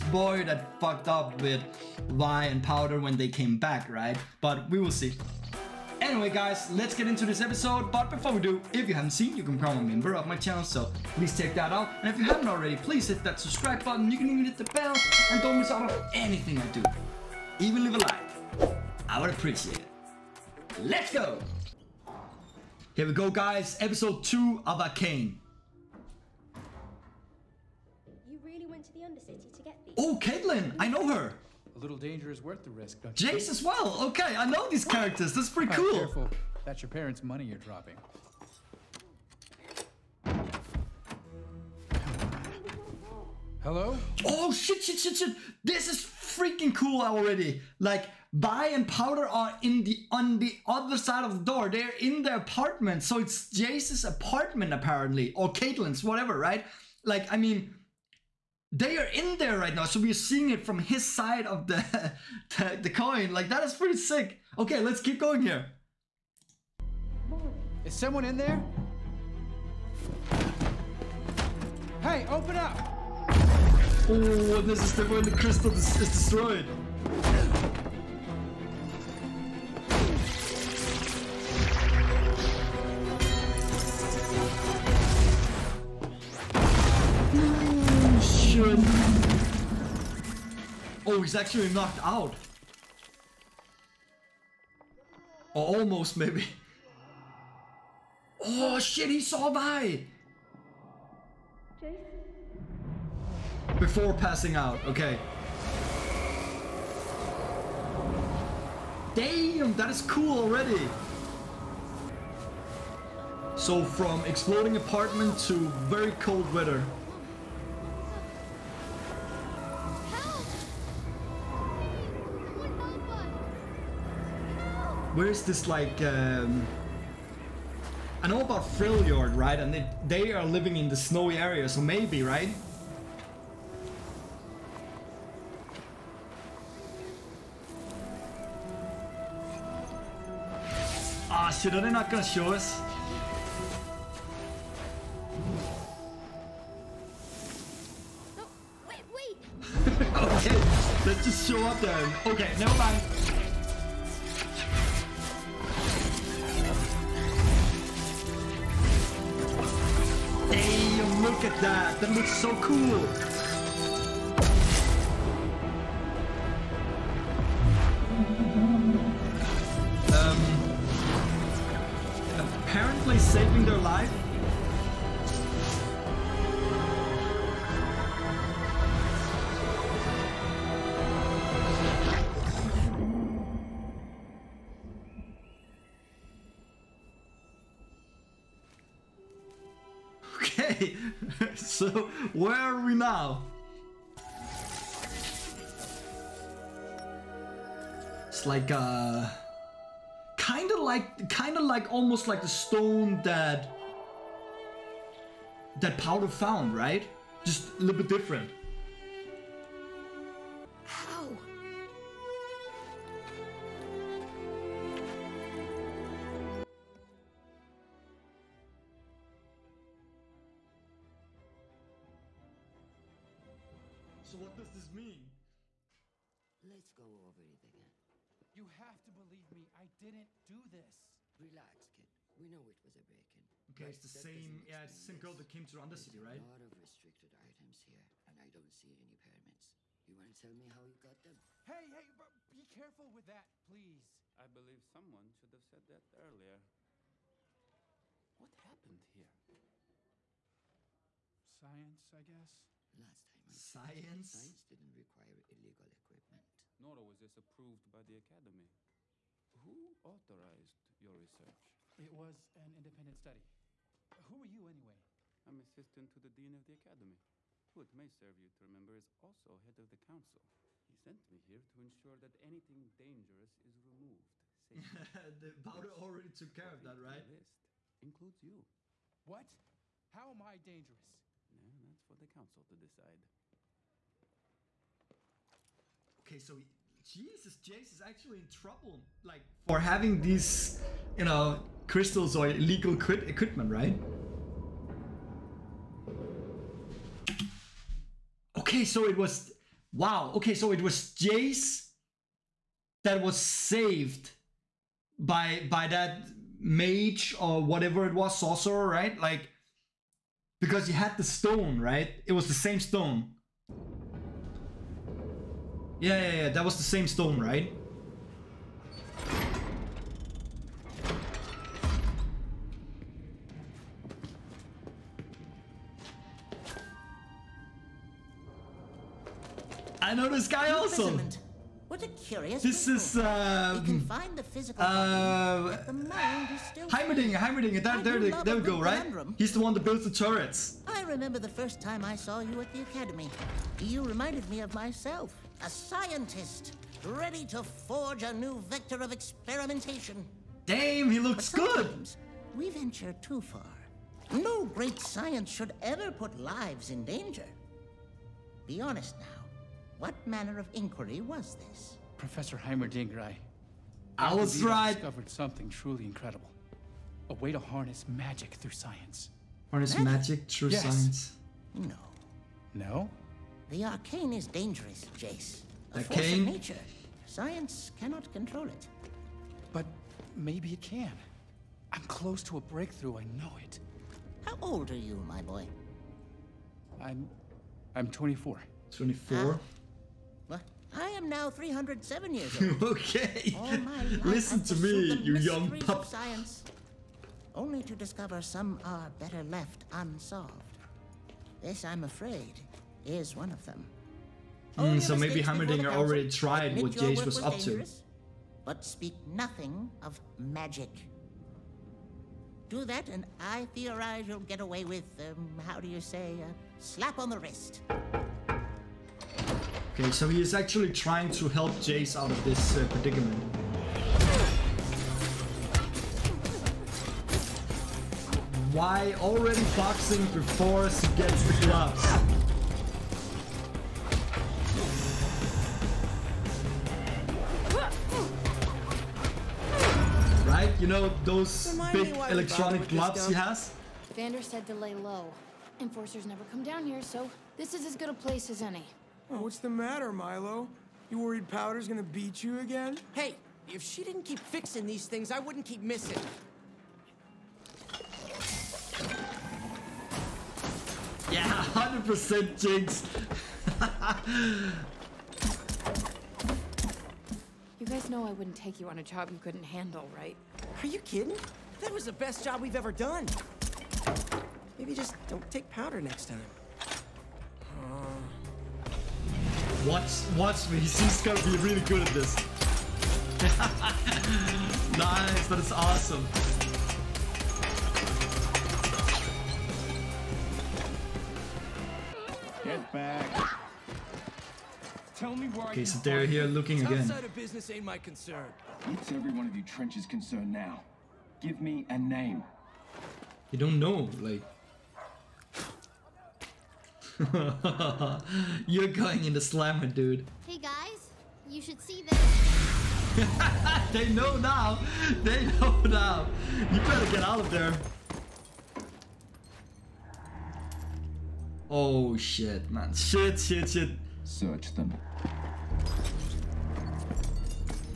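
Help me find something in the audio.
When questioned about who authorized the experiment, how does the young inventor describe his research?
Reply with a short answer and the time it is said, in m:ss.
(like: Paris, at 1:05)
independent study, at 4:22.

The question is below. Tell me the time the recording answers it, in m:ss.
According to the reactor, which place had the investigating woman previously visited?
3:55.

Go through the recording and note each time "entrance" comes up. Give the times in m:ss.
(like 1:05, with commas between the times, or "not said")
not said.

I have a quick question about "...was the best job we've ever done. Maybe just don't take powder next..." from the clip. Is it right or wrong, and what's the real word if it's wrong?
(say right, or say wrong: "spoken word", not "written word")
right.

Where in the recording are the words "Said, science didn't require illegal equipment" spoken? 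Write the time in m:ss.
4:14.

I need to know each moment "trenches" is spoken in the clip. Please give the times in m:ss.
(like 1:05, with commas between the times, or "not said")
8:19.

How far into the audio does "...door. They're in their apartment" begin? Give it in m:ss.
0:51.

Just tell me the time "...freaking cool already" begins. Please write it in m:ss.
0:45.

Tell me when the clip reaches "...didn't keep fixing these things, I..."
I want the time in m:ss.
7:34.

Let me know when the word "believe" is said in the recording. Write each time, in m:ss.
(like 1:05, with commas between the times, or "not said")
3:49, 4:04.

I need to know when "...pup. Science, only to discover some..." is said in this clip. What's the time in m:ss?
6:35.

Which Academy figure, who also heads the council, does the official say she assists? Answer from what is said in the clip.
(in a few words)
the Dean.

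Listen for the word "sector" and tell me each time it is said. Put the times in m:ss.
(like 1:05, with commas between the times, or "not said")
not said.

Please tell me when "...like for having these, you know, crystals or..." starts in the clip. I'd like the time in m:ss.
4:49.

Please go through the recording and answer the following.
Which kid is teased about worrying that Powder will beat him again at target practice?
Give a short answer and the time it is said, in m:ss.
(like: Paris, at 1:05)
Milo, at 7:30.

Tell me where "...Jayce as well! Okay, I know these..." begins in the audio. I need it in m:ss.
0:33.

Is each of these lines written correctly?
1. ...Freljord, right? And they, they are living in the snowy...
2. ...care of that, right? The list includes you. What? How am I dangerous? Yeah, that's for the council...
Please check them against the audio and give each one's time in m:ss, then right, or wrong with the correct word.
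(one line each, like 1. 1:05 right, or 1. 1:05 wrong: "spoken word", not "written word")
1. 2:08 right
2. 4:36 right.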